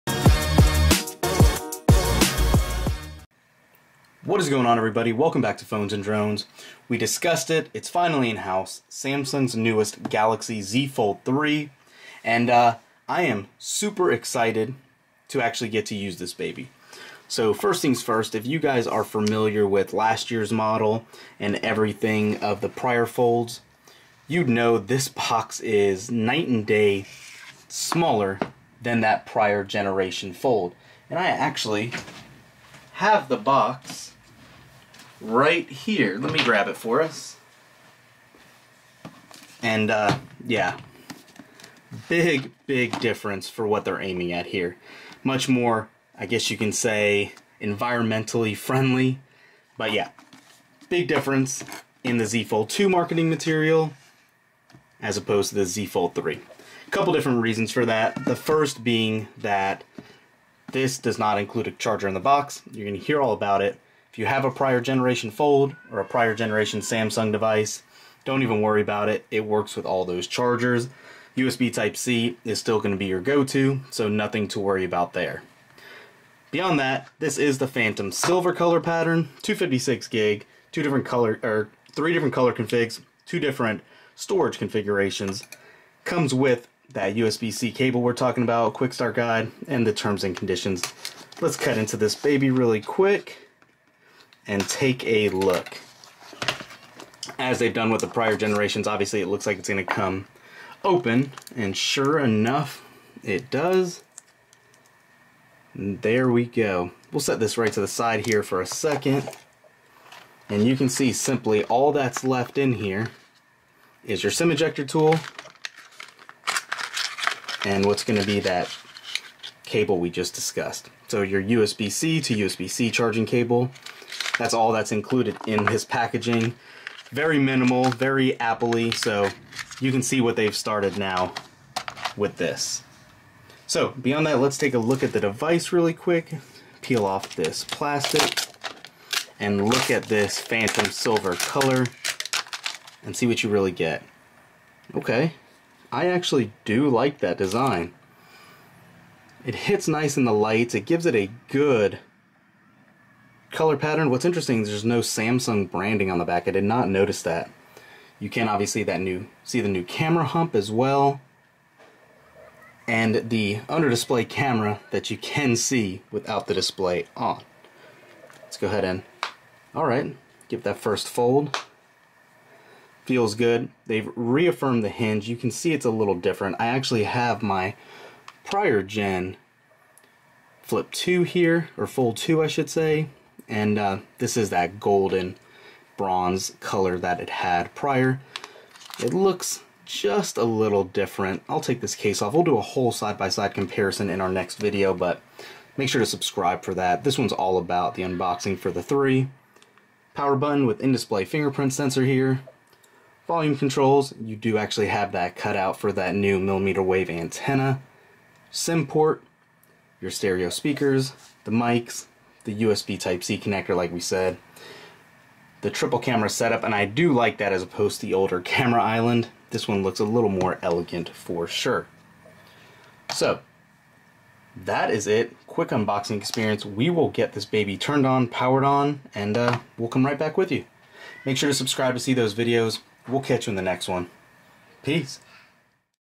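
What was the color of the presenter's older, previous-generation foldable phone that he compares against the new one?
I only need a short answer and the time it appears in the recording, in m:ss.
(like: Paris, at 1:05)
Golden bronze, at 3:04.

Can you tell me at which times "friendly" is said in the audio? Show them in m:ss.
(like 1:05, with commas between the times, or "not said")
0:48.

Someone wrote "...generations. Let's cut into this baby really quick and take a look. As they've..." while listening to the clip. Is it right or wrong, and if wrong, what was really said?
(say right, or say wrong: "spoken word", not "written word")
wrong: "conditions", not "generations".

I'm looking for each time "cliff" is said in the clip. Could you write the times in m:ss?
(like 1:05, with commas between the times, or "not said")
not said.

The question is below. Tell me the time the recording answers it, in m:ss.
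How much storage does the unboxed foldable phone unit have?
1:19.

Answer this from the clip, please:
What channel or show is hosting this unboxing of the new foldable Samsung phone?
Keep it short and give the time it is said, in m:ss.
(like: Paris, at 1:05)
Phones and Drones, at 0:05.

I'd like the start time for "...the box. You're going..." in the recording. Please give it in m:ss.
1:02.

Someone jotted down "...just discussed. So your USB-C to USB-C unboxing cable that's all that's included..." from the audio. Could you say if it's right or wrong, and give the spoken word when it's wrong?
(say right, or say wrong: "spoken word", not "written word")
wrong: "charging", not "unboxing".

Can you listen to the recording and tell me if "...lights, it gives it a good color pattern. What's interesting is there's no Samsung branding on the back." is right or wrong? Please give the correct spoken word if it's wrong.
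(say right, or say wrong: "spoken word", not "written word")
right.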